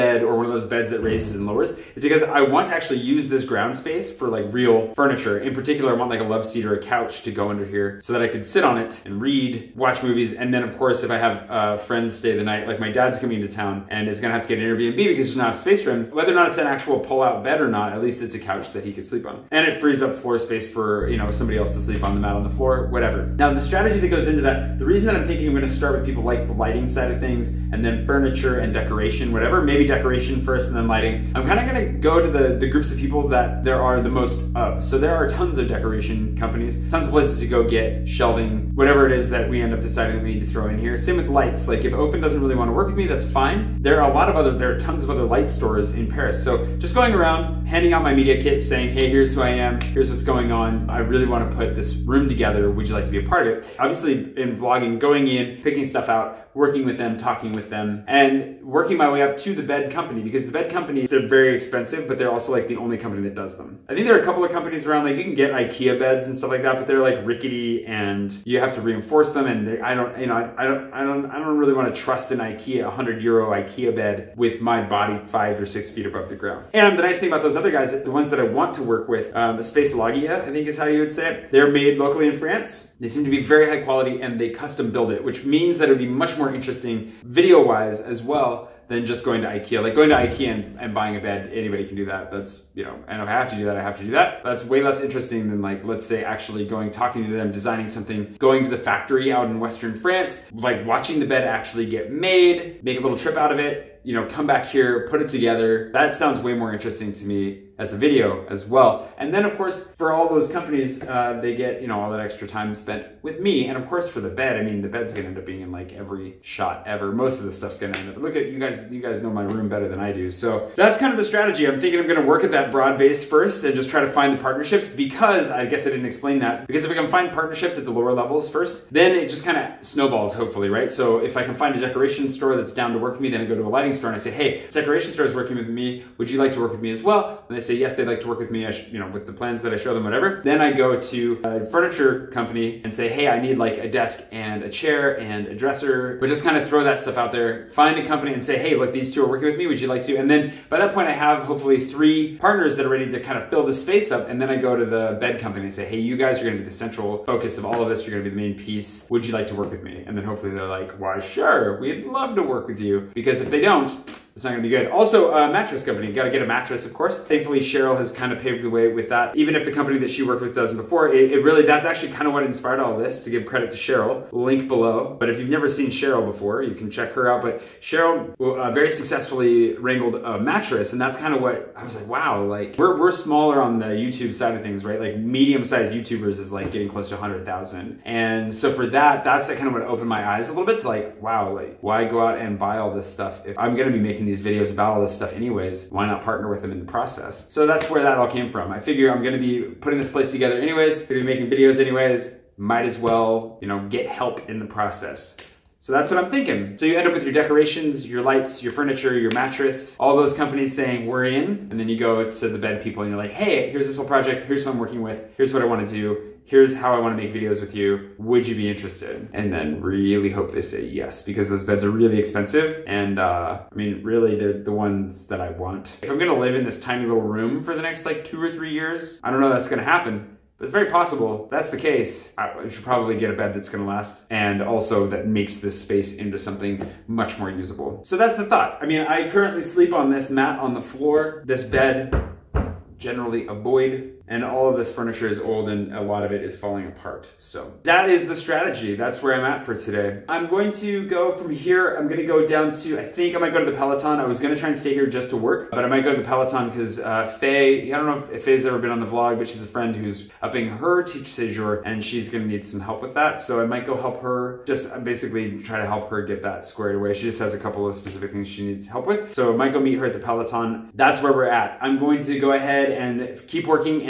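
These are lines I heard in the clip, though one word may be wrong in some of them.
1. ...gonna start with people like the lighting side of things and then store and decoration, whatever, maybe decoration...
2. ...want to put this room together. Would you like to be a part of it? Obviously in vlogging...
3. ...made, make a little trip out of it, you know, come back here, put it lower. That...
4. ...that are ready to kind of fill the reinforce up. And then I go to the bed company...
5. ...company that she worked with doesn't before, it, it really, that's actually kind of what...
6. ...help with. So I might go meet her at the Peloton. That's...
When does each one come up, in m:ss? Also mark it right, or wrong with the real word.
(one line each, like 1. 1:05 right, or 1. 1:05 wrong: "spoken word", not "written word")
1. 0:25 wrong: "furniture", not "store"
2. 0:51 right
3. 1:42 wrong: "together", not "lower"
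4. 2:32 wrong: "space", not "reinforce"
5. 2:49 right
6. 4:28 right.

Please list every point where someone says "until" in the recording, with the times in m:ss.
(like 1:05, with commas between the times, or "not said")
not said.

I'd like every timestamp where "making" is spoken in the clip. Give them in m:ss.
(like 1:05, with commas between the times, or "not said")
3:13, 3:21.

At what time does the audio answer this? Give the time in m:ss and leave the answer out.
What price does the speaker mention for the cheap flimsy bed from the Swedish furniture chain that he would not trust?
1:12.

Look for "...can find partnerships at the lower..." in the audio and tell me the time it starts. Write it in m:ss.
2:06.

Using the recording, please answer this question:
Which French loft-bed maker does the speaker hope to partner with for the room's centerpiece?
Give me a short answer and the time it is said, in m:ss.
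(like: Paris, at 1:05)
Space Loggia, at 1:19.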